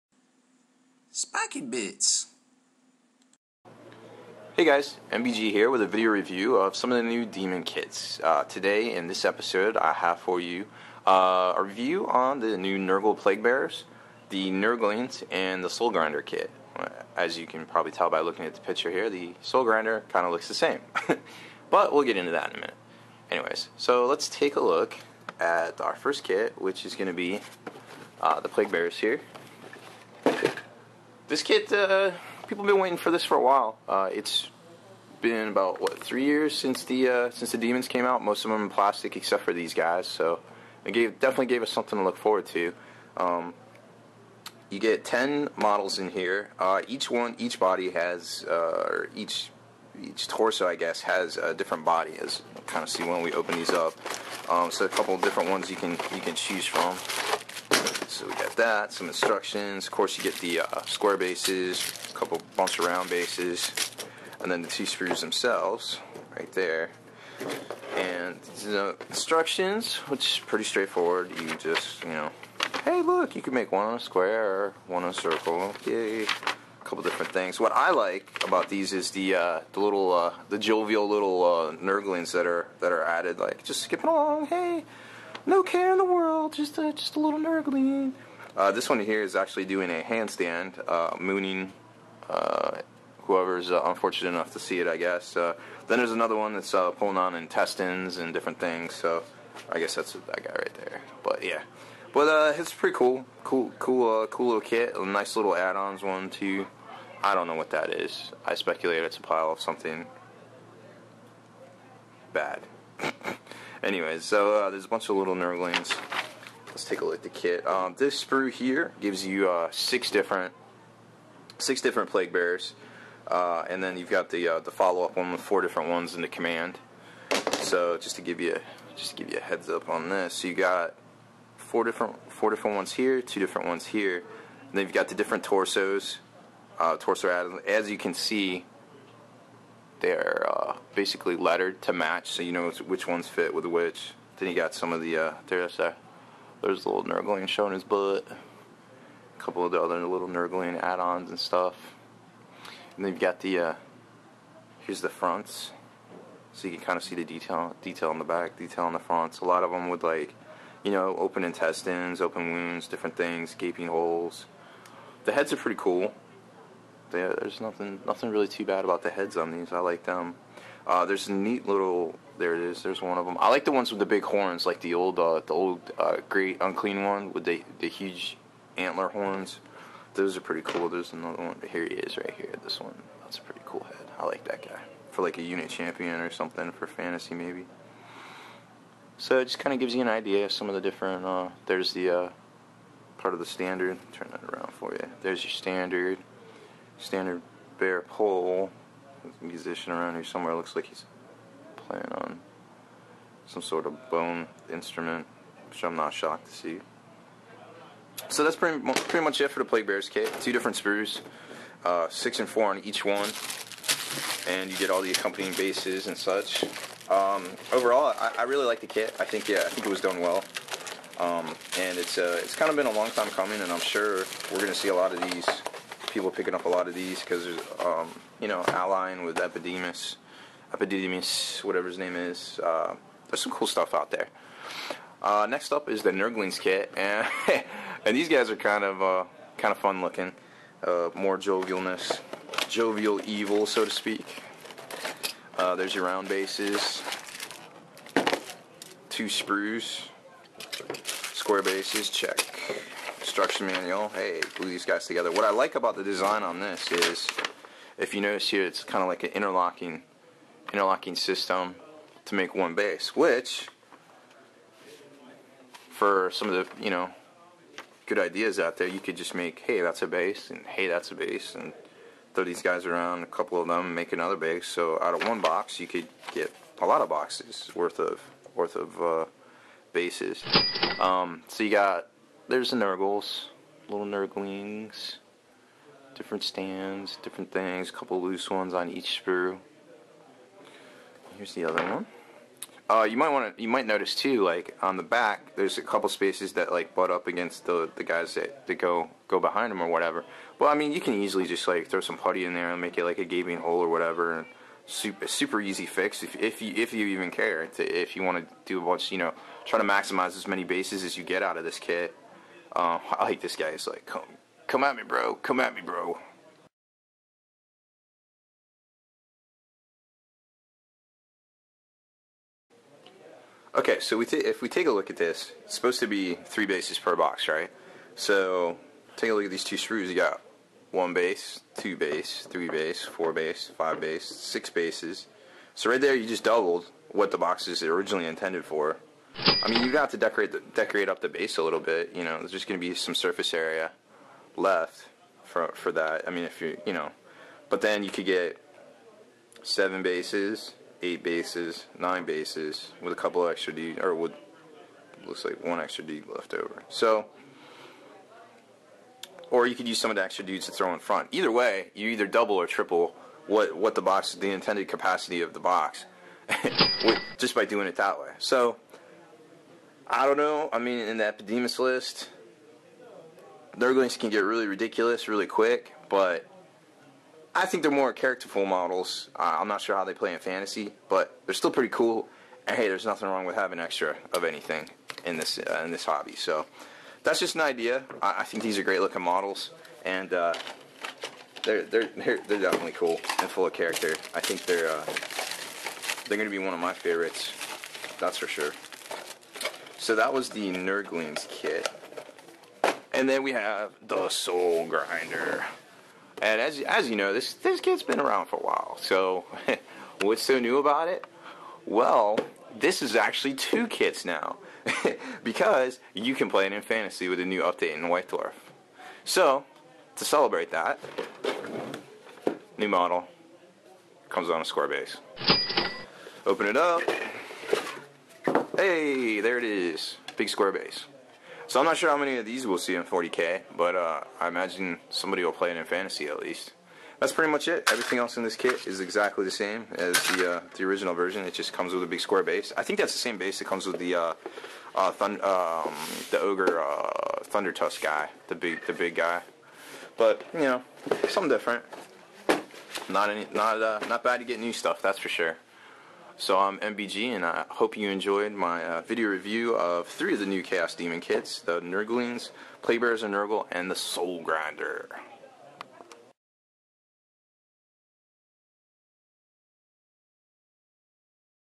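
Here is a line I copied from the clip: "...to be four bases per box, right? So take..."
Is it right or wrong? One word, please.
wrong.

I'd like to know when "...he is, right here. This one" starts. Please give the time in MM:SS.
03:01.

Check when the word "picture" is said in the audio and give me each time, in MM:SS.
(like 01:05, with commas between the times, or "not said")
00:18.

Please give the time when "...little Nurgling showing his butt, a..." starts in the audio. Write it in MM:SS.
02:26.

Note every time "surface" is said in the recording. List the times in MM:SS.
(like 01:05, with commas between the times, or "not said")
05:43.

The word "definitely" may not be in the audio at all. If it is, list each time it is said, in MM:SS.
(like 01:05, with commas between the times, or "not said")
00:41, 06:32.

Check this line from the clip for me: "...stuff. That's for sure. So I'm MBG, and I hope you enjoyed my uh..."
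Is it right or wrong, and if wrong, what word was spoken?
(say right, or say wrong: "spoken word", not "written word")
right.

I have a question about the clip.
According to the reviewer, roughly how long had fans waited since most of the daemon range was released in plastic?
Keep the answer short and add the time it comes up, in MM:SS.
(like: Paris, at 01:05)
3 years, at 00:36.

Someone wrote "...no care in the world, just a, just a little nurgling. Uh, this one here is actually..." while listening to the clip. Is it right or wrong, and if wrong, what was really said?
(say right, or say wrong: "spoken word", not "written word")
right.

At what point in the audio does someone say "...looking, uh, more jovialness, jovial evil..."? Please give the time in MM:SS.
04:00.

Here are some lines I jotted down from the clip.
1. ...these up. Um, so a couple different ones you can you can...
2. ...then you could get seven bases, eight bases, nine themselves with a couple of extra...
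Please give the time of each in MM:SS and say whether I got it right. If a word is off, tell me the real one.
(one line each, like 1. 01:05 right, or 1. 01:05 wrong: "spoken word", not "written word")
1. 00:53 right
2. 05:47 wrong: "bases", not "themselves".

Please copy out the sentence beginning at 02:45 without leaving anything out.
The heads are pretty cool there's nothing nothing really too bad about the heads on these.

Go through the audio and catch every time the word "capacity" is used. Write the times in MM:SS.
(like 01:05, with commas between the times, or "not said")
06:04.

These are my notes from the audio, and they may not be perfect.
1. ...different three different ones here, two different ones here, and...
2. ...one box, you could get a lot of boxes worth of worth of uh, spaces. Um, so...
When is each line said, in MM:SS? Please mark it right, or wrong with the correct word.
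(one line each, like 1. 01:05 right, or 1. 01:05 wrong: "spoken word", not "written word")
1. 02:11 wrong: "four", not "three"
2. 04:35 wrong: "bases", not "spaces".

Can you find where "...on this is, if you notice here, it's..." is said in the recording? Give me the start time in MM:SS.
04:16.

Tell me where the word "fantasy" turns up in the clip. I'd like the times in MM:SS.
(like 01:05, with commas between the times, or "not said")
03:06, 06:20, 06:56, 07:15.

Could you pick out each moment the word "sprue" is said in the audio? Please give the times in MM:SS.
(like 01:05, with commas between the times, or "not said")
01:58, 03:30, 04:09, 04:49.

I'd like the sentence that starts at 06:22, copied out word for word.
And hey, there's nothing wrong with having extra of anything in this uh, in this hobby.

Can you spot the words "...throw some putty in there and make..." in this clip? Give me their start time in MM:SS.
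05:01.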